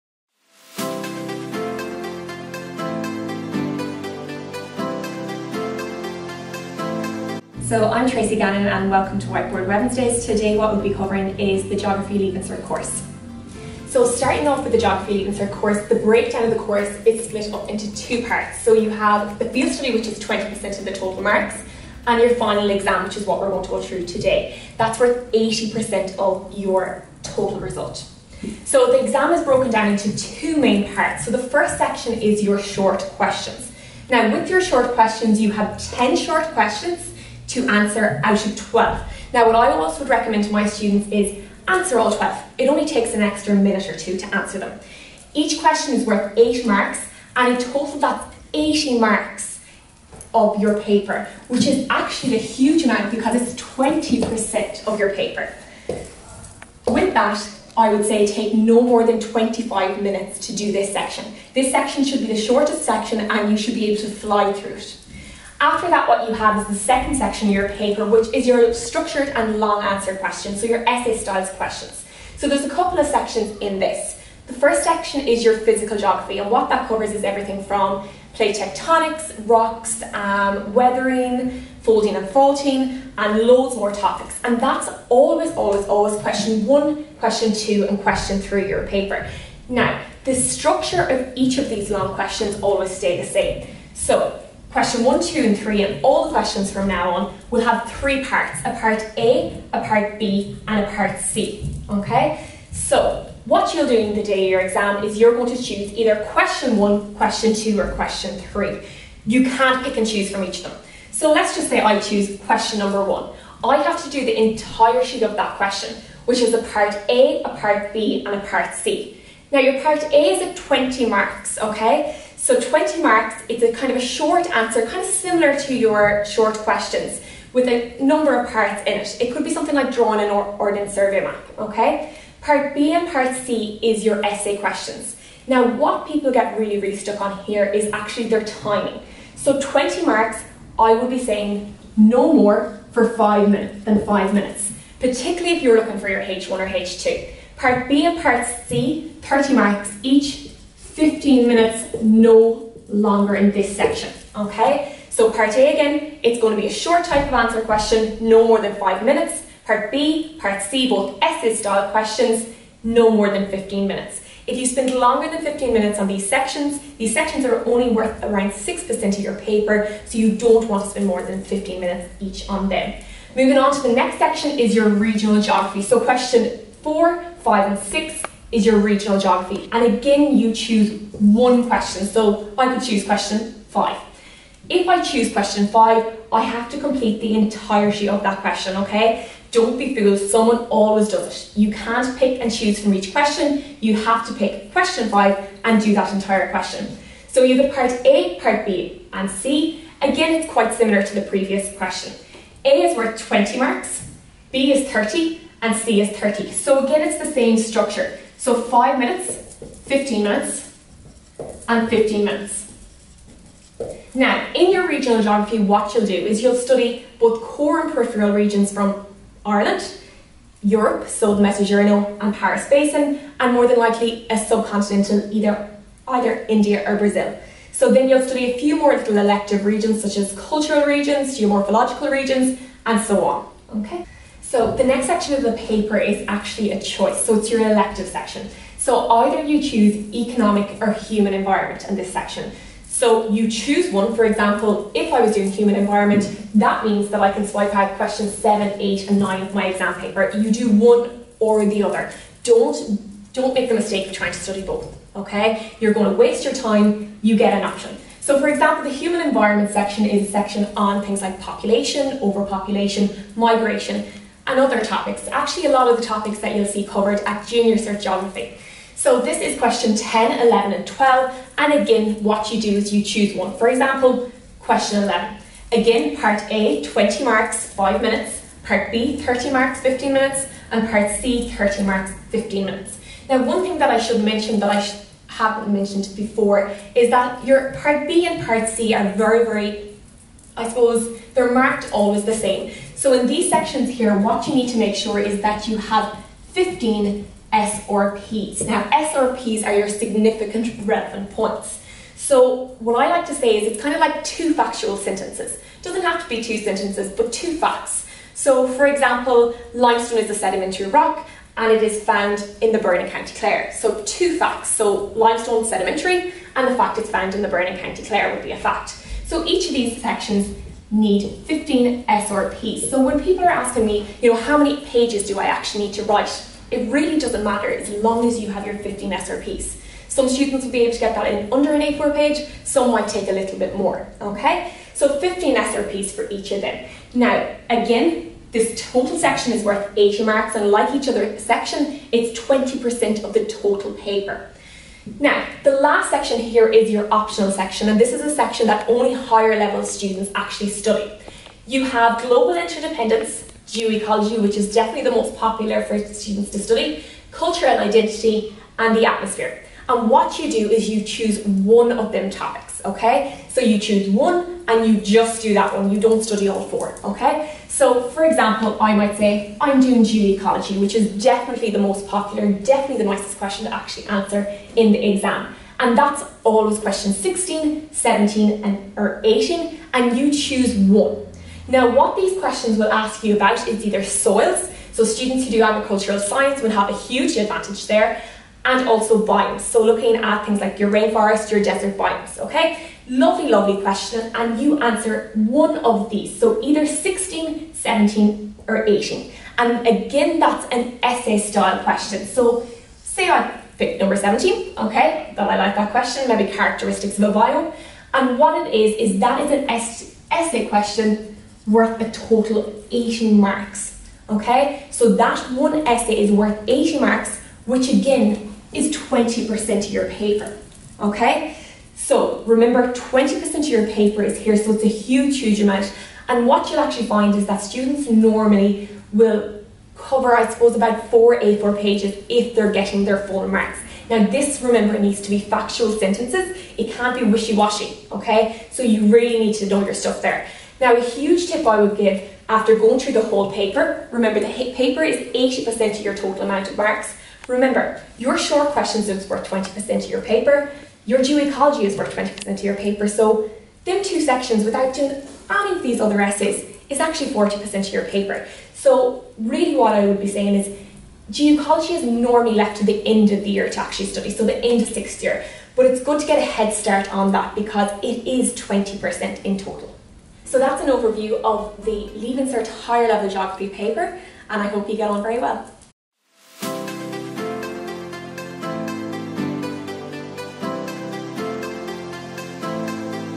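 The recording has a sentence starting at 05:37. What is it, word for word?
Now, again, this total section is worth 80 marks, and like each other section, it's 20% of the total paper.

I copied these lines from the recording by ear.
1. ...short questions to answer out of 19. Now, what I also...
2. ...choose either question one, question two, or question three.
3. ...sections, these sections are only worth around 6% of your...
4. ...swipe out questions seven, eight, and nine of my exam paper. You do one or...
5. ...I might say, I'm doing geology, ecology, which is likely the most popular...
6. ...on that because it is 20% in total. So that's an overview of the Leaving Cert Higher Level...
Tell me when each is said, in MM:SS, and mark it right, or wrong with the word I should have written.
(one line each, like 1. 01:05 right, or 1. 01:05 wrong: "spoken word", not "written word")
1. 00:36 wrong: "12", not "19"
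2. 01:45 right
3. 02:46 right
4. 04:07 right
5. 06:08 wrong: "definitely", not "likely"
6. 07:47 right.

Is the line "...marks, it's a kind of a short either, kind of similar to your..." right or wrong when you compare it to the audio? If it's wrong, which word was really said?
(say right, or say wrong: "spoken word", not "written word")
wrong: "answer", not "either".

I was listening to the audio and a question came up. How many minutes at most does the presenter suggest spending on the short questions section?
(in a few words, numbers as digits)
25 minutes.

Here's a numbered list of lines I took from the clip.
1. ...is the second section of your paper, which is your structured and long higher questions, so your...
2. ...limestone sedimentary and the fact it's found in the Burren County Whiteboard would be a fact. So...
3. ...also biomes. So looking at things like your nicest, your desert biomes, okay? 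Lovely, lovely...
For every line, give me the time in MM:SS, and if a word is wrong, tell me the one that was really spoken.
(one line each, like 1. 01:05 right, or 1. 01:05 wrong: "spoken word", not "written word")
1. 01:06 wrong: "answer", not "higher"
2. 05:15 wrong: "Clare", not "Whiteboard"
3. 06:28 wrong: "rainforest", not "nicest".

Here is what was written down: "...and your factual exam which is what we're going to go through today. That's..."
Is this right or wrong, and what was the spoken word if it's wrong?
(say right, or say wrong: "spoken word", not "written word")
wrong: "final", not "factual".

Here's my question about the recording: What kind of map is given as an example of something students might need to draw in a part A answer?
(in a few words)
Ordnance survey map.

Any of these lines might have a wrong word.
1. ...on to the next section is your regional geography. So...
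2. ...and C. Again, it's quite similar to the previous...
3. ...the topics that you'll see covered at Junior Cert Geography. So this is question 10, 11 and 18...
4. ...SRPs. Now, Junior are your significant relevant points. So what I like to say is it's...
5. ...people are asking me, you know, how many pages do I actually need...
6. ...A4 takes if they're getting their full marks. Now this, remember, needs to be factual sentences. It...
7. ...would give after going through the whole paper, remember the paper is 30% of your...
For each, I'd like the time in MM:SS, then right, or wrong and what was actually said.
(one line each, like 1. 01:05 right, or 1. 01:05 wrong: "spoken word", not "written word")
1. 02:53 right
2. 03:19 right
3. 04:25 wrong: "12", not "18"
4. 04:57 wrong: "SRPs", not "Junior"
5. 05:23 right
6. 07:11 wrong: "pages", not "takes"
7. 07:21 wrong: "80", not "30".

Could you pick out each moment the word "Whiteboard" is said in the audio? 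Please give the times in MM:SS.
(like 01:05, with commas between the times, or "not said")
00:09.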